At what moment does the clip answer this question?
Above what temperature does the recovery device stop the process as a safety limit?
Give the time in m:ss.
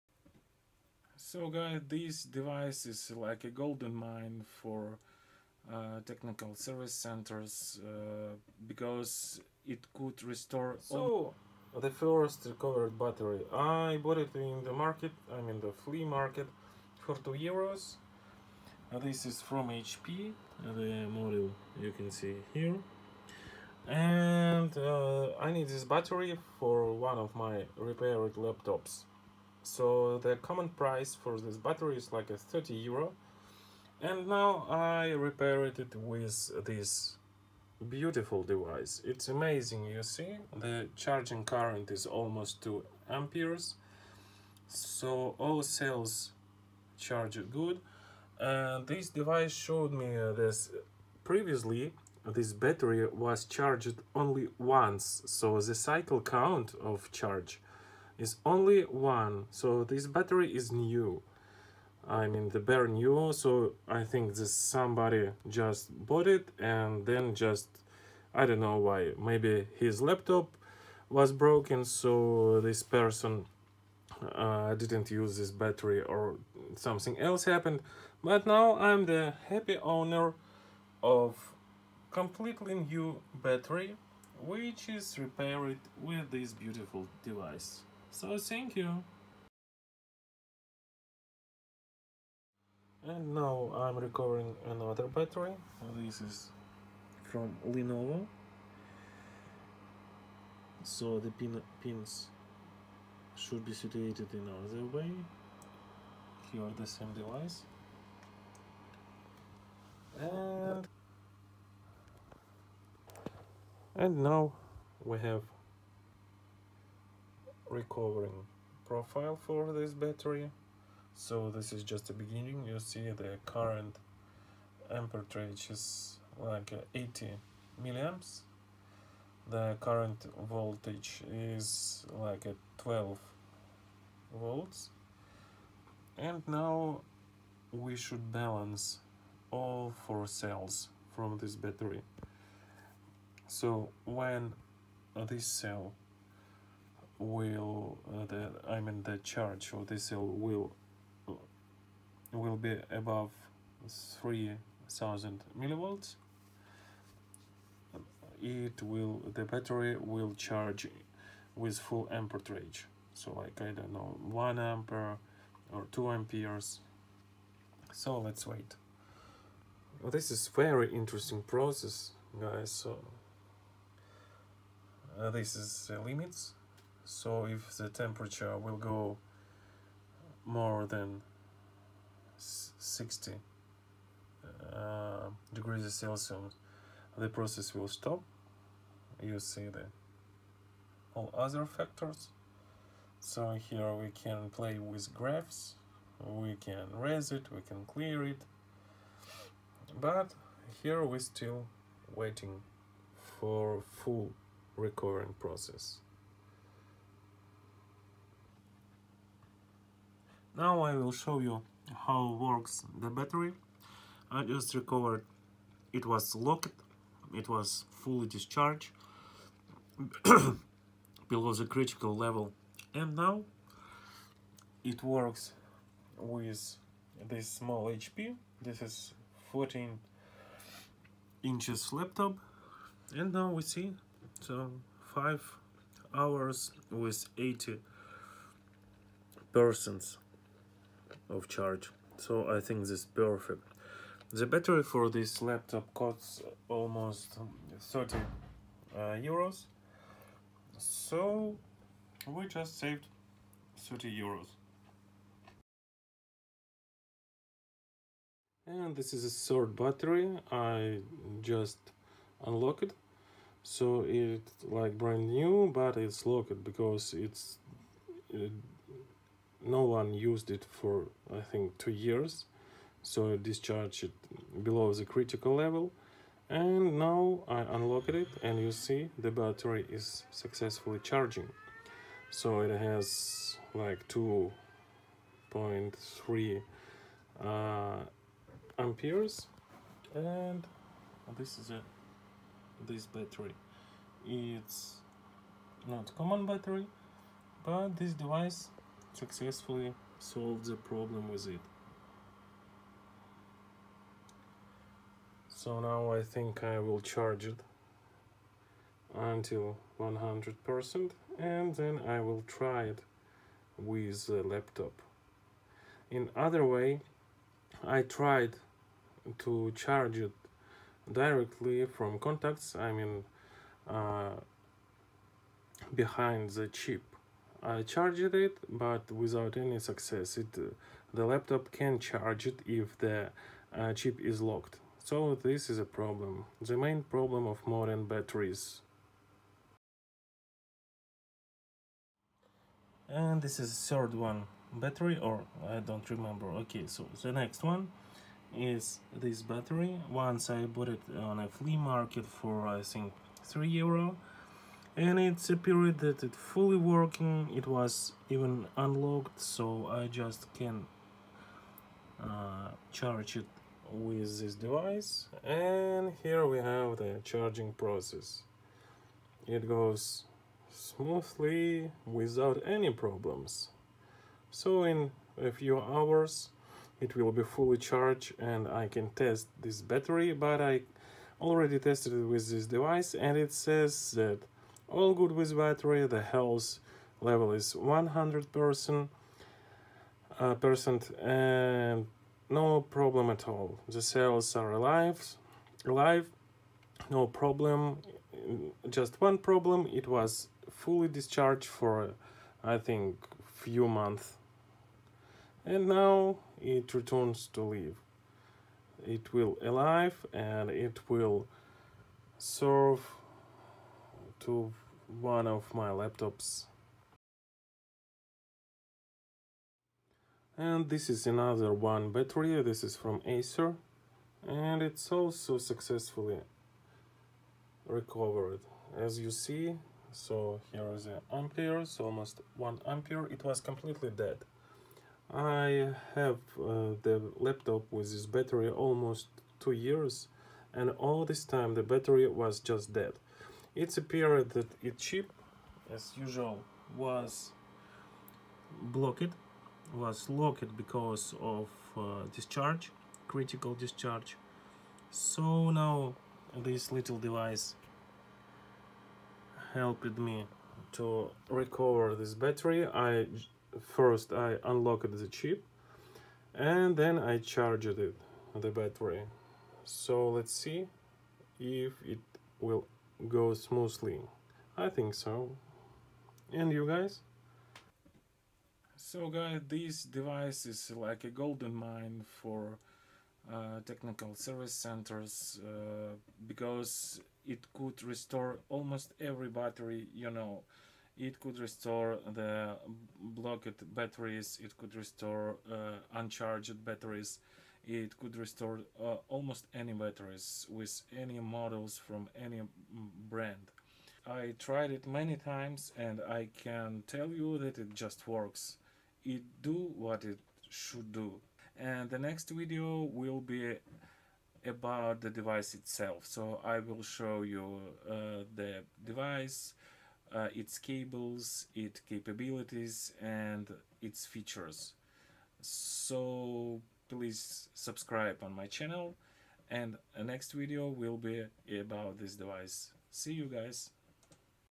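3:02.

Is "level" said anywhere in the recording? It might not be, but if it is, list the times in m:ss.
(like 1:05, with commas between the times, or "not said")
3:42, 4:35, 6:27.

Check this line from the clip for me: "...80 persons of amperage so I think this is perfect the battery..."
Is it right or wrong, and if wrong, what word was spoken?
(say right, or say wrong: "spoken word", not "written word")
wrong: "charge", not "amperage".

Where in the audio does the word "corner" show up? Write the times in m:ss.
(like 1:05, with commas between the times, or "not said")
not said.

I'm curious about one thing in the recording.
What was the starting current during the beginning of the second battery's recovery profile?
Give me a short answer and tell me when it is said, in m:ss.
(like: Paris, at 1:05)
80 milliamps, at 2:06.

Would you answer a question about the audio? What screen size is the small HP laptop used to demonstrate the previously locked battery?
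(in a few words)
14 inches.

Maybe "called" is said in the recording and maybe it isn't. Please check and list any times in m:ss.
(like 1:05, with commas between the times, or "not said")
not said.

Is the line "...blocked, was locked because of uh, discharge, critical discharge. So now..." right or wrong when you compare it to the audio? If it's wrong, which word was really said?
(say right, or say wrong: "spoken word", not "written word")
right.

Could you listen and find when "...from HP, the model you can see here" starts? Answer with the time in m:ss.
0:19.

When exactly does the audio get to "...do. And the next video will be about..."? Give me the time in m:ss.
8:31.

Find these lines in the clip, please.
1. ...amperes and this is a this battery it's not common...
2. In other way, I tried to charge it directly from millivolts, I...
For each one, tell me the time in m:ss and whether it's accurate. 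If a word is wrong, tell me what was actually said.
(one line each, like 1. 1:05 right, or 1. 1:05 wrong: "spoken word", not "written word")
1. 4:48 right
2. 5:16 wrong: "contacts", not "millivolts".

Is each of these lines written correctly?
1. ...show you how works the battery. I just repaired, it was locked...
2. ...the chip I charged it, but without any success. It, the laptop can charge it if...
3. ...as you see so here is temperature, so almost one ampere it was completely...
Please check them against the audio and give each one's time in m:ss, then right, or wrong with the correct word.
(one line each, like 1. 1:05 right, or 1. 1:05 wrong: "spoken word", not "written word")
1. 3:31 wrong: "recovered", not "repaired"
2. 5:26 right
3. 7:08 wrong: "ampere", not "temperature".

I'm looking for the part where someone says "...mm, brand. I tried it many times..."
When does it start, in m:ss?
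8:22.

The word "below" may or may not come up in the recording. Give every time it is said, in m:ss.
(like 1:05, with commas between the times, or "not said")
3:41, 4:34.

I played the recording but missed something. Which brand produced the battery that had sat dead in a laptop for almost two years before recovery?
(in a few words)
Acer.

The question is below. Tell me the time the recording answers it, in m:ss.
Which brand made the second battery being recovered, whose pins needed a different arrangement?
1:37.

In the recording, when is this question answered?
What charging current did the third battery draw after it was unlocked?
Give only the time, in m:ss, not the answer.
4:44.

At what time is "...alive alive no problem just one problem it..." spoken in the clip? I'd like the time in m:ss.
6:34.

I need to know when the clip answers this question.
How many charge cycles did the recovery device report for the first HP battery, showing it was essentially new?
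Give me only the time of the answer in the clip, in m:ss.
0:58.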